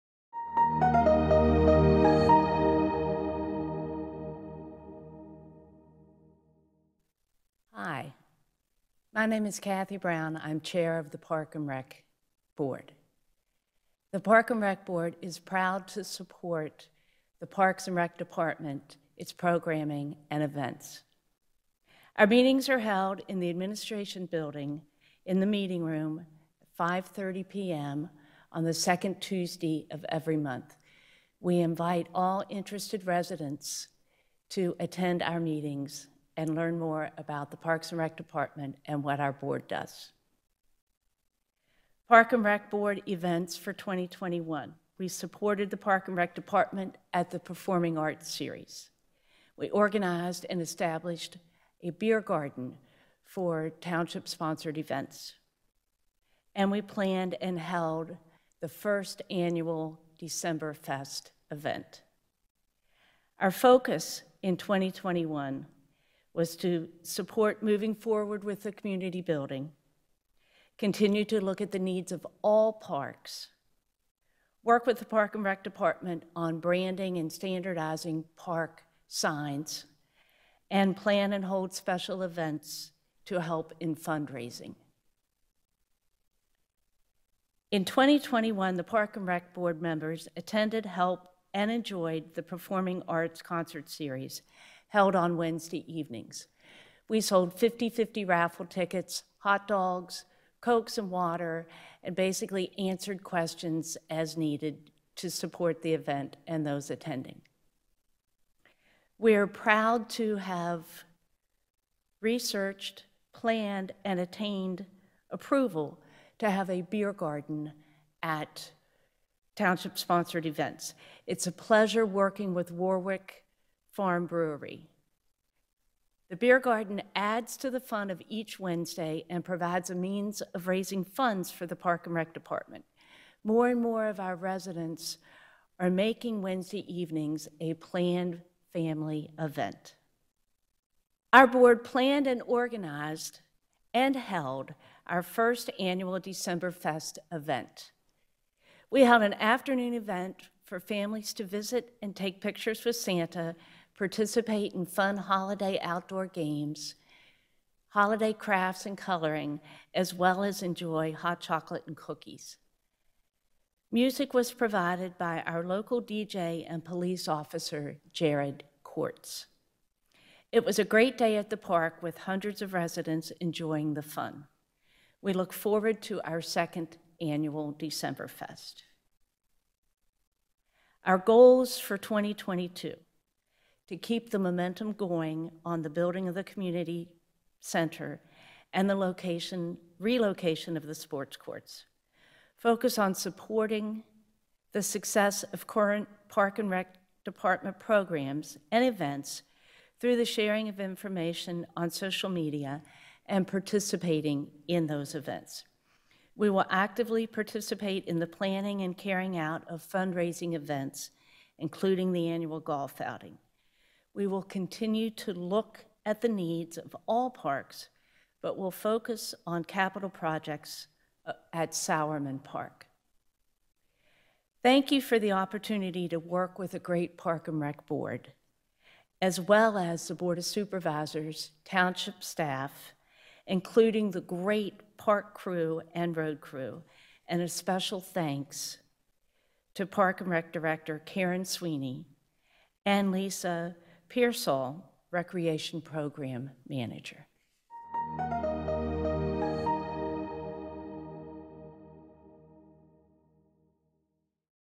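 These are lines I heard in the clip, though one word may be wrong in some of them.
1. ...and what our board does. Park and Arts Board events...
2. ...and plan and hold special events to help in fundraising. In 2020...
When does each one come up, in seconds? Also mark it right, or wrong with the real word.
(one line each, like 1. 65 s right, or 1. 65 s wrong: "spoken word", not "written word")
1. 38 s wrong: "Rec", not "Arts"
2. 80 s wrong: "2021", not "2020".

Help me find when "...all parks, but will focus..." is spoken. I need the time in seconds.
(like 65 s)
217 s.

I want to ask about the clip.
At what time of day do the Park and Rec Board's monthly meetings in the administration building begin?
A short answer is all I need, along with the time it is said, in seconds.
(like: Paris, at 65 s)
5:30 p.m., at 26 s.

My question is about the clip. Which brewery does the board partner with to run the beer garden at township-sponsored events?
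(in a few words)
Warwick Farm Brewery.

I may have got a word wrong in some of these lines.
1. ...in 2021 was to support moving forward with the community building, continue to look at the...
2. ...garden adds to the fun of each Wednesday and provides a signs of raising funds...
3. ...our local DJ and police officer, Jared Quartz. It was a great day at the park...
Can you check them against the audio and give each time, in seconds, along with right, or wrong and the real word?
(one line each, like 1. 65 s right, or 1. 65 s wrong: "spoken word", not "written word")
1. 64 s right
2. 126 s wrong: "means", not "signs"
3. 165 s right.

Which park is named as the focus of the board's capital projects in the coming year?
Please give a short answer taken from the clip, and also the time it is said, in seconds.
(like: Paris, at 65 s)
Sowerman Park, at 221 s.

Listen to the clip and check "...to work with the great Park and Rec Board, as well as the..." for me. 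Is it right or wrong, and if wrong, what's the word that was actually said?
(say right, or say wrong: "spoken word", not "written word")
right.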